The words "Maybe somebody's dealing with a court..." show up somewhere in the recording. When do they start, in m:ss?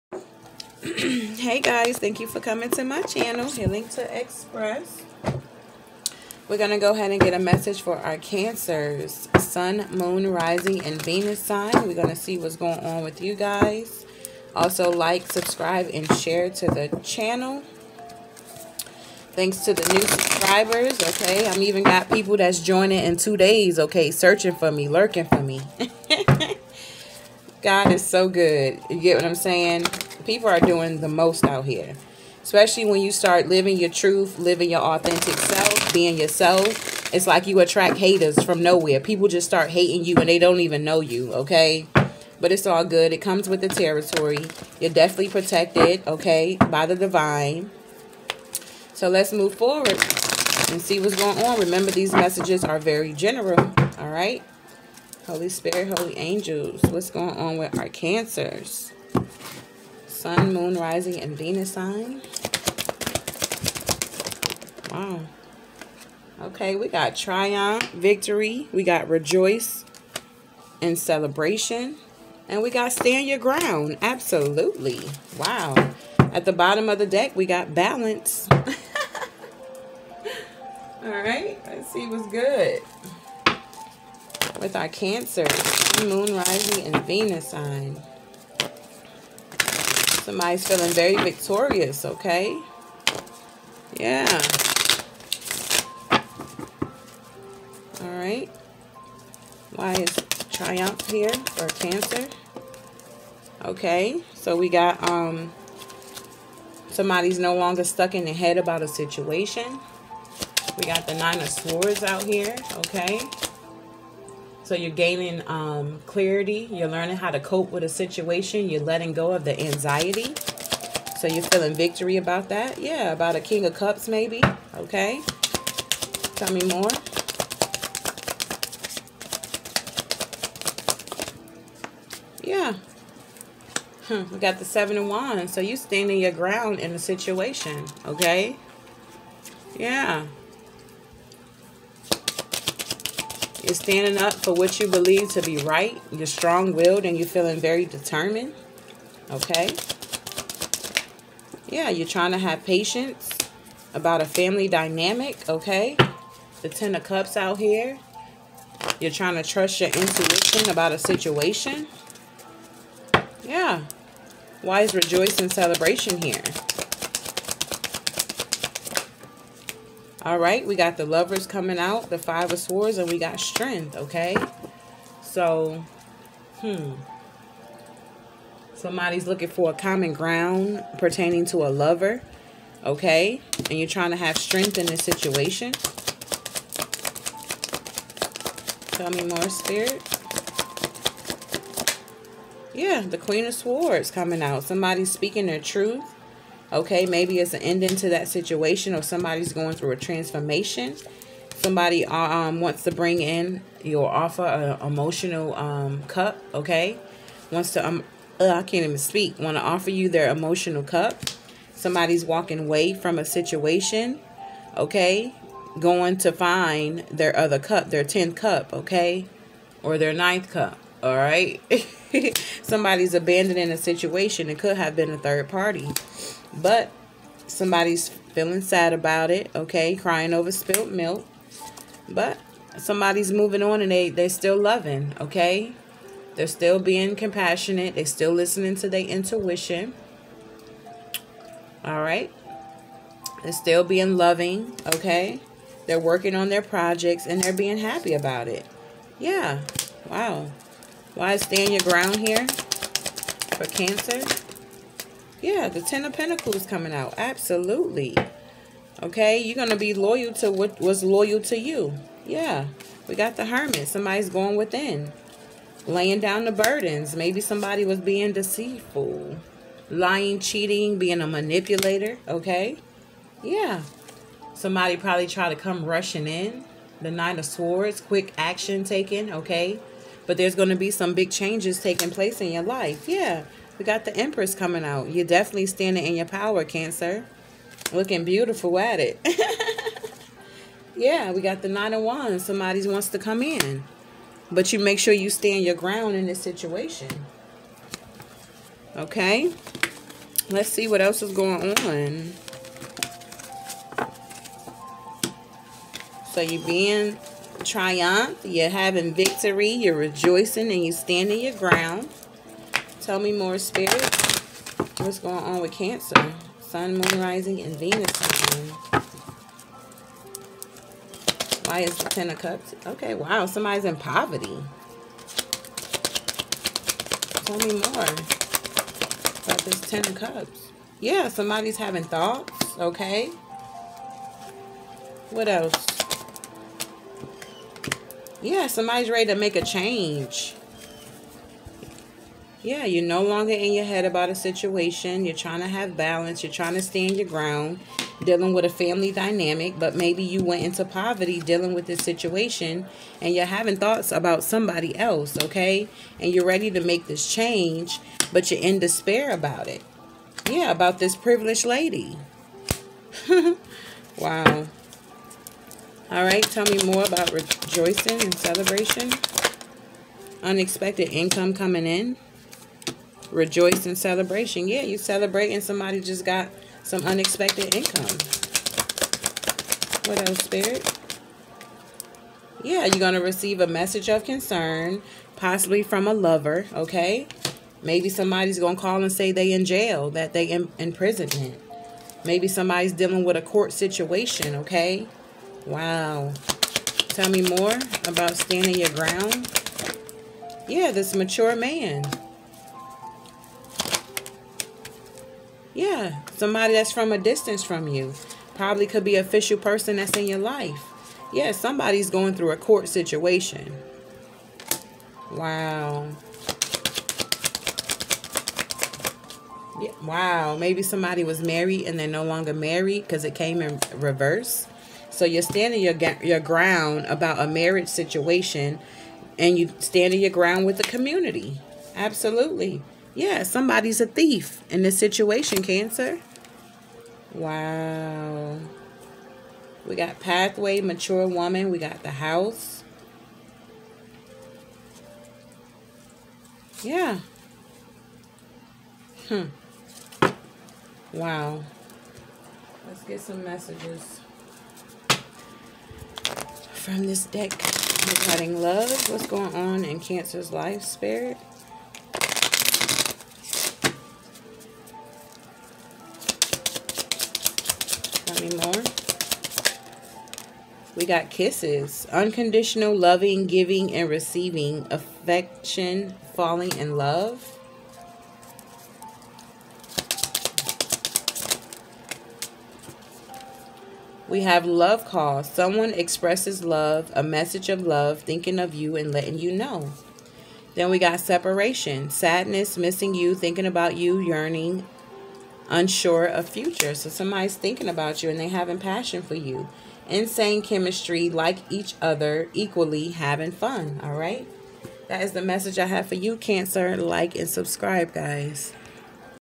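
6:32.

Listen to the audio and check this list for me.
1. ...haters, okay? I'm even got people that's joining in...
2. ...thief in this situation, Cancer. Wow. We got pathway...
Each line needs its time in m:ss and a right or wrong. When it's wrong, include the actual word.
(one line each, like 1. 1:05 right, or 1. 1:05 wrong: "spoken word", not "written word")
1. 0:20 wrong: "subscribers", not "haters"
2. 7:14 right.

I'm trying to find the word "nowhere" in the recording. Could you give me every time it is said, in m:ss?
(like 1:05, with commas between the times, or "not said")
0:38.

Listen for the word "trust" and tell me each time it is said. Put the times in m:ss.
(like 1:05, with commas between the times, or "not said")
2:39.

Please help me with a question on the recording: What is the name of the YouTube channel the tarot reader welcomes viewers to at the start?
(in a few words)
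Healing to Express.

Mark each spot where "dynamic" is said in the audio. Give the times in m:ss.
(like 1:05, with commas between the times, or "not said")
2:34, 5:49.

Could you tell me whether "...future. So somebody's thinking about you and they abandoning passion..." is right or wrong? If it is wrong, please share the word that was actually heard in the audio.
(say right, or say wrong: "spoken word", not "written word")
wrong: "having", not "abandoning".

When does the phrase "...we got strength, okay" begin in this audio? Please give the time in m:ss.
2:53.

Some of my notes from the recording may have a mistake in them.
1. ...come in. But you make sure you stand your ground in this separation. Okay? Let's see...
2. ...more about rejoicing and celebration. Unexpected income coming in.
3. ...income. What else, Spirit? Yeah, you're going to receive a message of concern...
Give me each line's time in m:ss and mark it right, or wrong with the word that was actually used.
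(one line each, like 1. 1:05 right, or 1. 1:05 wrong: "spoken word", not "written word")
1. 4:53 wrong: "situation", not "separation"
2. 6:06 right
3. 6:17 right.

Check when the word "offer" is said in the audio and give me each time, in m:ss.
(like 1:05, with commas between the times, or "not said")
3:24, 3:29.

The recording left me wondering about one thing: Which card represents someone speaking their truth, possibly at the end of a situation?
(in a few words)
Queen of Swords.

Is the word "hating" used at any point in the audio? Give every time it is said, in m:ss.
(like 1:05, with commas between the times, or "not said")
0:39.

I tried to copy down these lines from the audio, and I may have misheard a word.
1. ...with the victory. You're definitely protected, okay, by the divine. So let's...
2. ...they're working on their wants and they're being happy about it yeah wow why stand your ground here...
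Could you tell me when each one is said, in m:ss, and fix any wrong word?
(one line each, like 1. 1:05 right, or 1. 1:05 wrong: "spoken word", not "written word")
1. 0:43 wrong: "territory", not "victory"
2. 4:05 wrong: "projects", not "wants".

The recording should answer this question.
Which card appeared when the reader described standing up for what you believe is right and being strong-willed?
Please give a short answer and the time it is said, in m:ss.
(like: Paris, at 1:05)
Seven of Wands, at 2:14.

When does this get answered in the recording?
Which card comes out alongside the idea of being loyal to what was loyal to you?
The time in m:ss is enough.
4:15.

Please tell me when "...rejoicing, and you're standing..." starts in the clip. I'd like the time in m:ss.
5:09.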